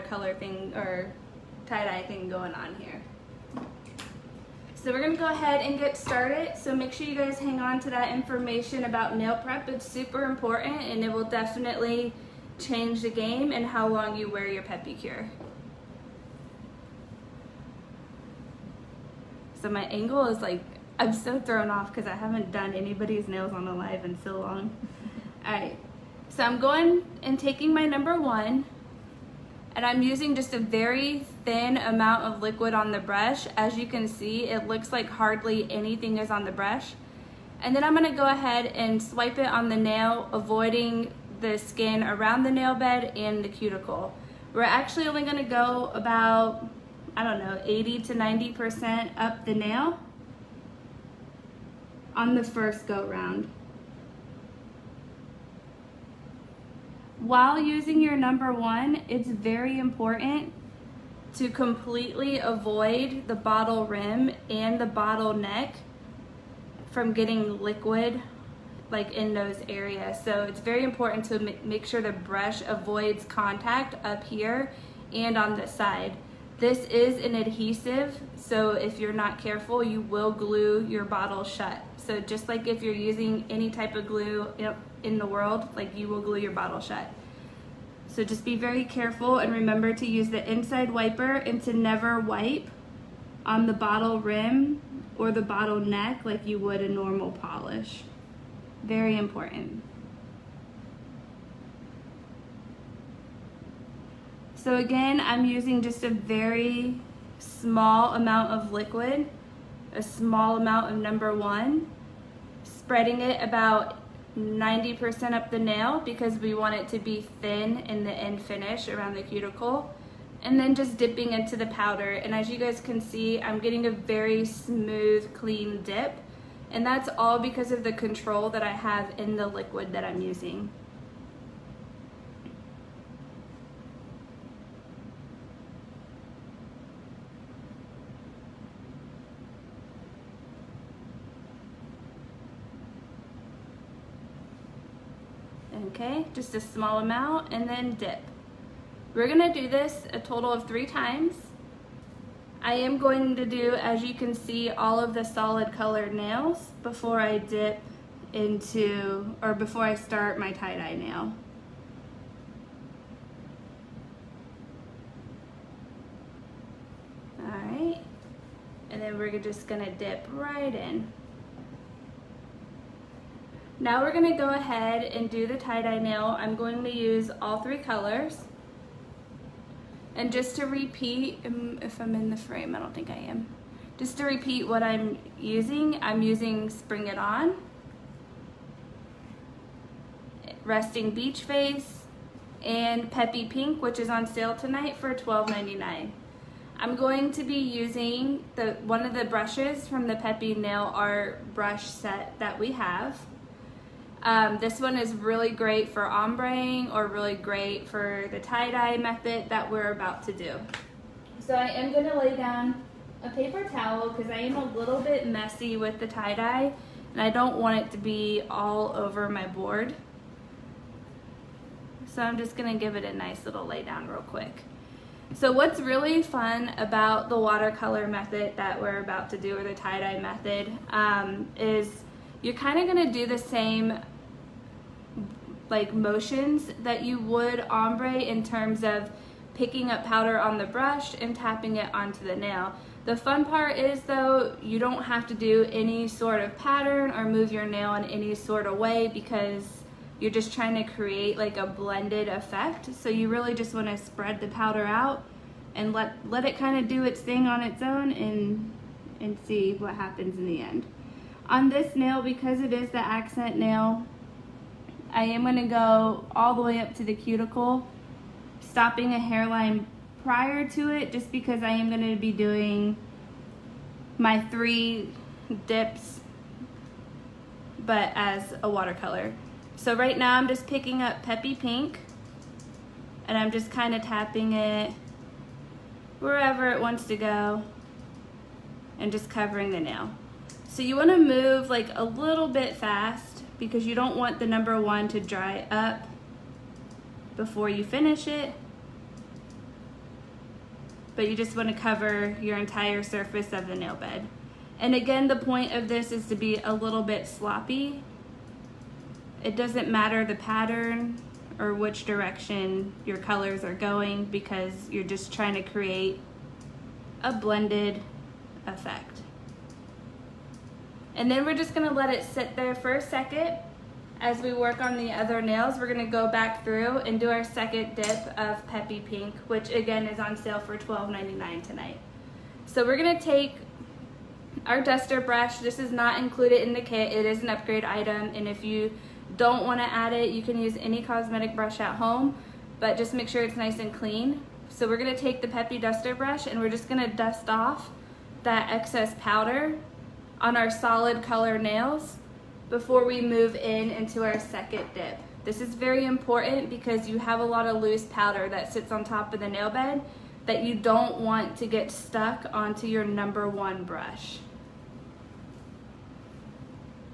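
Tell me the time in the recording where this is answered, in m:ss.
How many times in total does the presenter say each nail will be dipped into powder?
2:30.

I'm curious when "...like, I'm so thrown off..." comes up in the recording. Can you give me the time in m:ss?
0:20.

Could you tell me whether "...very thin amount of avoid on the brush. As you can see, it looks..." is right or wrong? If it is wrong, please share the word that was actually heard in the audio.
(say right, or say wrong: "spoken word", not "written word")
wrong: "liquid", not "avoid".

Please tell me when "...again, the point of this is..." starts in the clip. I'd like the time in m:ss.
5:04.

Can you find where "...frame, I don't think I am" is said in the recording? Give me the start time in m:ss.
3:02.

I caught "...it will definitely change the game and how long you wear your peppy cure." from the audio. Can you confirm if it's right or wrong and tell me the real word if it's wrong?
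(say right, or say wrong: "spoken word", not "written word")
right.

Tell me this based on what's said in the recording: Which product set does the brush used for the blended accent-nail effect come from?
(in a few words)
Peppi Nail Art brush set.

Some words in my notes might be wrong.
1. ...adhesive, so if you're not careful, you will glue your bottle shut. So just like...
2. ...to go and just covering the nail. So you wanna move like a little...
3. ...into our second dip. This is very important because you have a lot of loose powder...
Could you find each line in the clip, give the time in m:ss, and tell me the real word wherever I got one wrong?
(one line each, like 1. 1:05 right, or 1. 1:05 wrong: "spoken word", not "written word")
1. 1:17 right
2. 4:47 right
3. 5:53 right.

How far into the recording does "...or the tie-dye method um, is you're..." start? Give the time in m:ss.
3:49.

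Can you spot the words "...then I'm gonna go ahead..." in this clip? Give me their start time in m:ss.
0:37.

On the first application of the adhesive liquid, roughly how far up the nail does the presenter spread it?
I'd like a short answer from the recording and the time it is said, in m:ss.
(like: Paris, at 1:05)
80 to 90%, at 0:47.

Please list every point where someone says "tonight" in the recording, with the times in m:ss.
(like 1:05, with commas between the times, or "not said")
3:14, 5:31.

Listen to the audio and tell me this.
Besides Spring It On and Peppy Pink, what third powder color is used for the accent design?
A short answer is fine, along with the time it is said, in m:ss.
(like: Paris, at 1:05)
Resting Beach Face, at 3:10.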